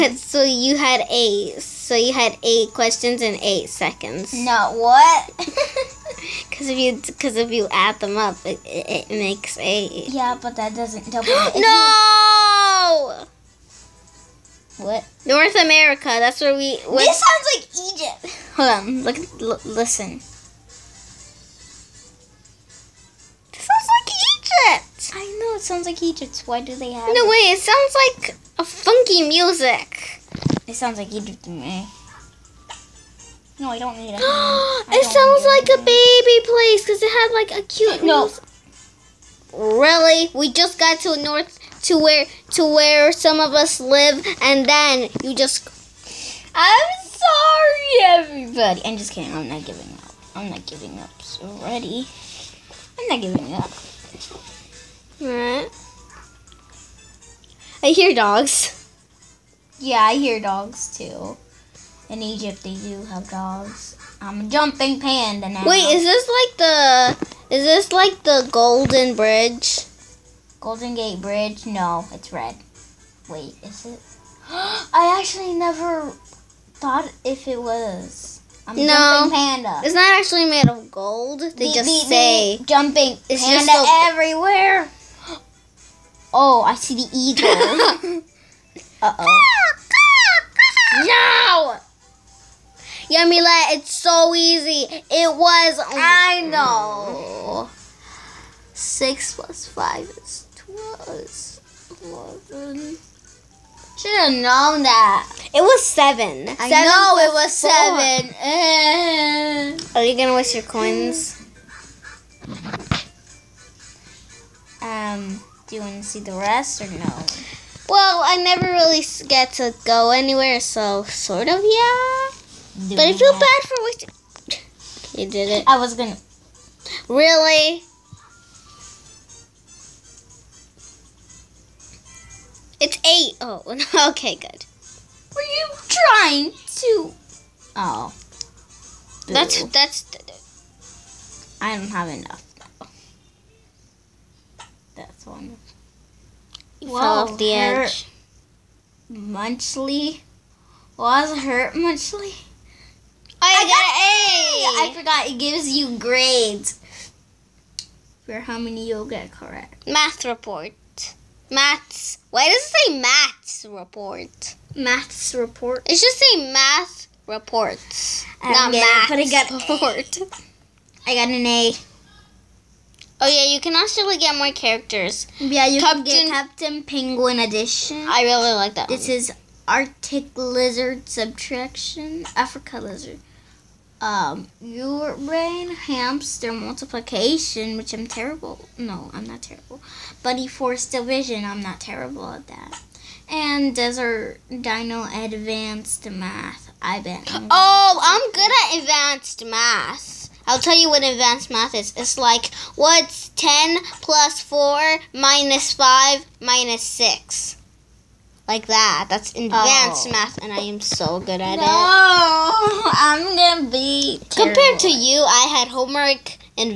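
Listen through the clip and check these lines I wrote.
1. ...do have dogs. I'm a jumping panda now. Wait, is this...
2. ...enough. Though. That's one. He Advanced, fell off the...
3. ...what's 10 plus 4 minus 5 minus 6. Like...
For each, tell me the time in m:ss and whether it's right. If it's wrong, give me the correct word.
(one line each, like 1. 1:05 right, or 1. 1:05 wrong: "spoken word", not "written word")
1. 1:02 right
2. 2:22 wrong: "Whoa", not "Advanced"
3. 3:22 right.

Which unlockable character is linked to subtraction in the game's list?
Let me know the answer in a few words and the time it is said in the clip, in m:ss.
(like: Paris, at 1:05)
Arctic Lizard, at 2:59.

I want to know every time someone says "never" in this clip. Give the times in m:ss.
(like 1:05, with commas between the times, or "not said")
1:15, 1:58.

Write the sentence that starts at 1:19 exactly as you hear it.
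It's not actually made of gold.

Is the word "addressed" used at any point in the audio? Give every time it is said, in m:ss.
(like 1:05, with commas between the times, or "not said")
not said.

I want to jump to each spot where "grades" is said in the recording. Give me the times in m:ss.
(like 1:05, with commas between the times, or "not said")
2:35.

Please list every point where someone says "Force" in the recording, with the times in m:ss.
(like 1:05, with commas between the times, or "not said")
3:10.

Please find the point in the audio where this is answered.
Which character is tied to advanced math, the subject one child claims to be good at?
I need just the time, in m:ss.
3:13.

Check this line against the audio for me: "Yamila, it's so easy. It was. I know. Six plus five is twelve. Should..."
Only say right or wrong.
right.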